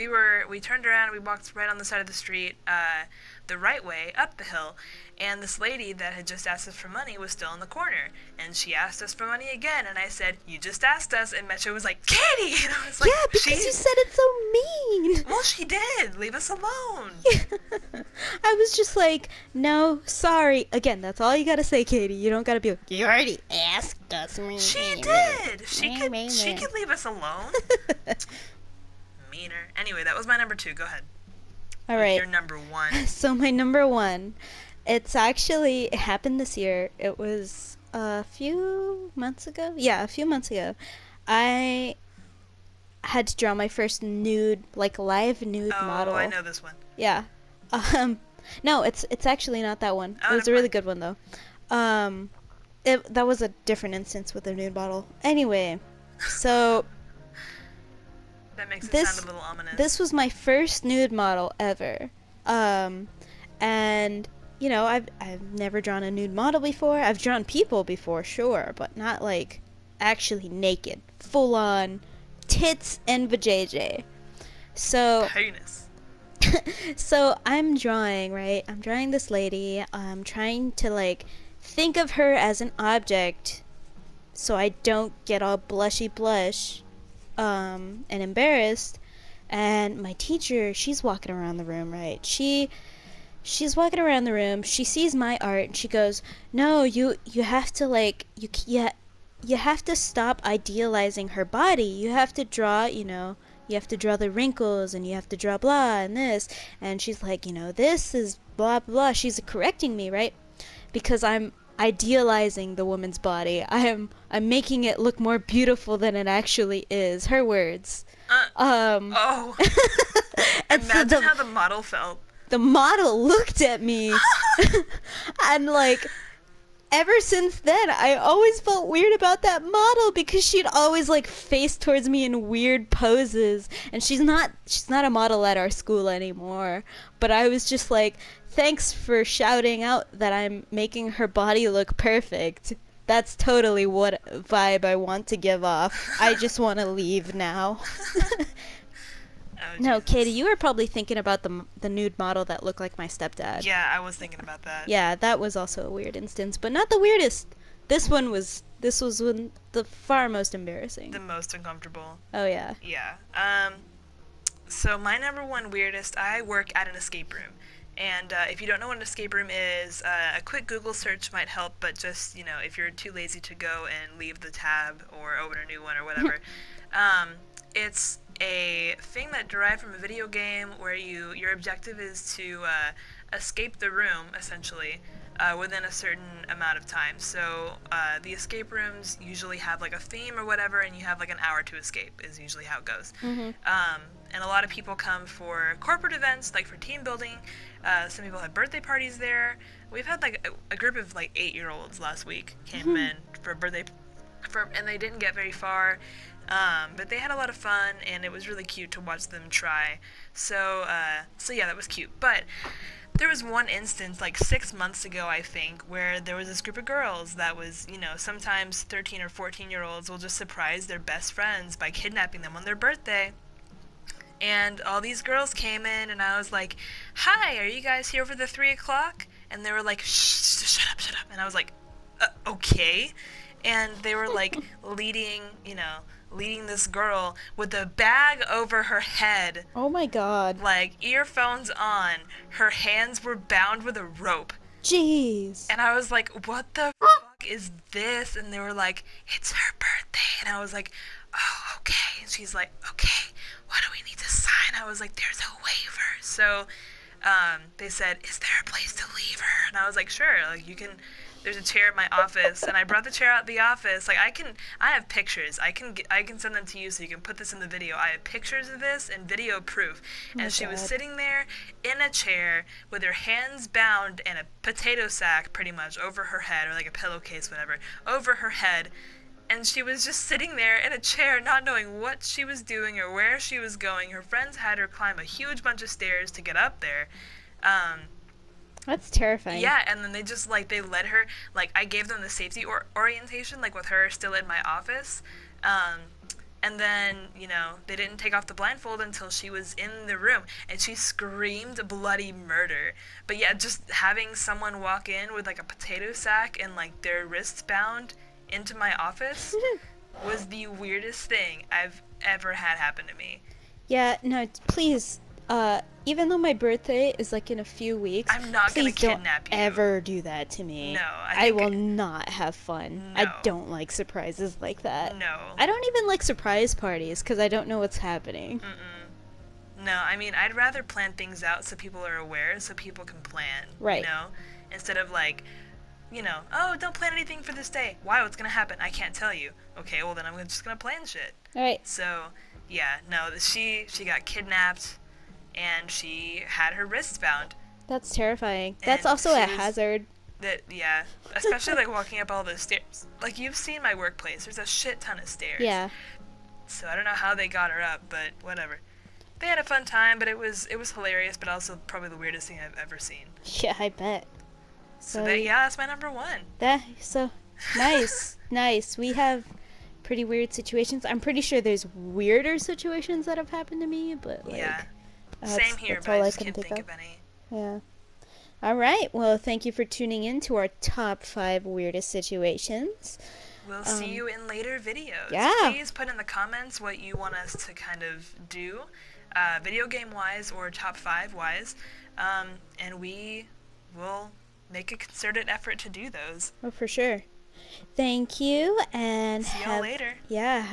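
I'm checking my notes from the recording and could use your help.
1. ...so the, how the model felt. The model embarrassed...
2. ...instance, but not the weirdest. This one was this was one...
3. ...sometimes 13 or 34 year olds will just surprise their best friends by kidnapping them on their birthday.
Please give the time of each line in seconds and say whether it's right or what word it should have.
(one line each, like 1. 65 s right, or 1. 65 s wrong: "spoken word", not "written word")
1. 121 s wrong: "looked", not "embarrassed"
2. 156 s right
3. 218 s wrong: "14", not "34".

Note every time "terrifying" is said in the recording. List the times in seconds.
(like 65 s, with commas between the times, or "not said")
289 s, 348 s.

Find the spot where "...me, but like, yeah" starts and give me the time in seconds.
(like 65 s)
373 s.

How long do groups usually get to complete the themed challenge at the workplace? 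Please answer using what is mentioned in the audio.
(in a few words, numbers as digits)
An hour.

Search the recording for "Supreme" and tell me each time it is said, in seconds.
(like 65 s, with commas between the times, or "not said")
not said.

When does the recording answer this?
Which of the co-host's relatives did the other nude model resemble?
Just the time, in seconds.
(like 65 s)
152 s.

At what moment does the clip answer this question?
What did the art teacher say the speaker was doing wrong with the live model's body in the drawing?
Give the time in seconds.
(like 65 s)
100 s.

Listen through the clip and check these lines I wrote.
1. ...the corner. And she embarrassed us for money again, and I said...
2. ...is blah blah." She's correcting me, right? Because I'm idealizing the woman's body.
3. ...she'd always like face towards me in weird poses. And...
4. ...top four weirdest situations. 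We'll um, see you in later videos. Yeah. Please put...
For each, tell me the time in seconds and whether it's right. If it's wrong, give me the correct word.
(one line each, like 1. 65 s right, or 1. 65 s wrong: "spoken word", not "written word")
1. 7 s wrong: "asked", not "embarrassed"
2. 108 s right
3. 130 s right
4. 380 s wrong: "five", not "four".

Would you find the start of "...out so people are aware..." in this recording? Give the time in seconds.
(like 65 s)
331 s.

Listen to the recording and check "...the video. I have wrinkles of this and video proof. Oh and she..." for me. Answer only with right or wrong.
wrong.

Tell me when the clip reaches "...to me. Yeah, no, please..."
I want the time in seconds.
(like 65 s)
313 s.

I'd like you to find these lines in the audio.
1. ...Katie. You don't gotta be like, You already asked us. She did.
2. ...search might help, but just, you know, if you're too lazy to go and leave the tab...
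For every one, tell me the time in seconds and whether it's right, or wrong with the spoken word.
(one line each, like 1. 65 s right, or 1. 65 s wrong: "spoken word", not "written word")
1. 21 s right
2. 170 s right.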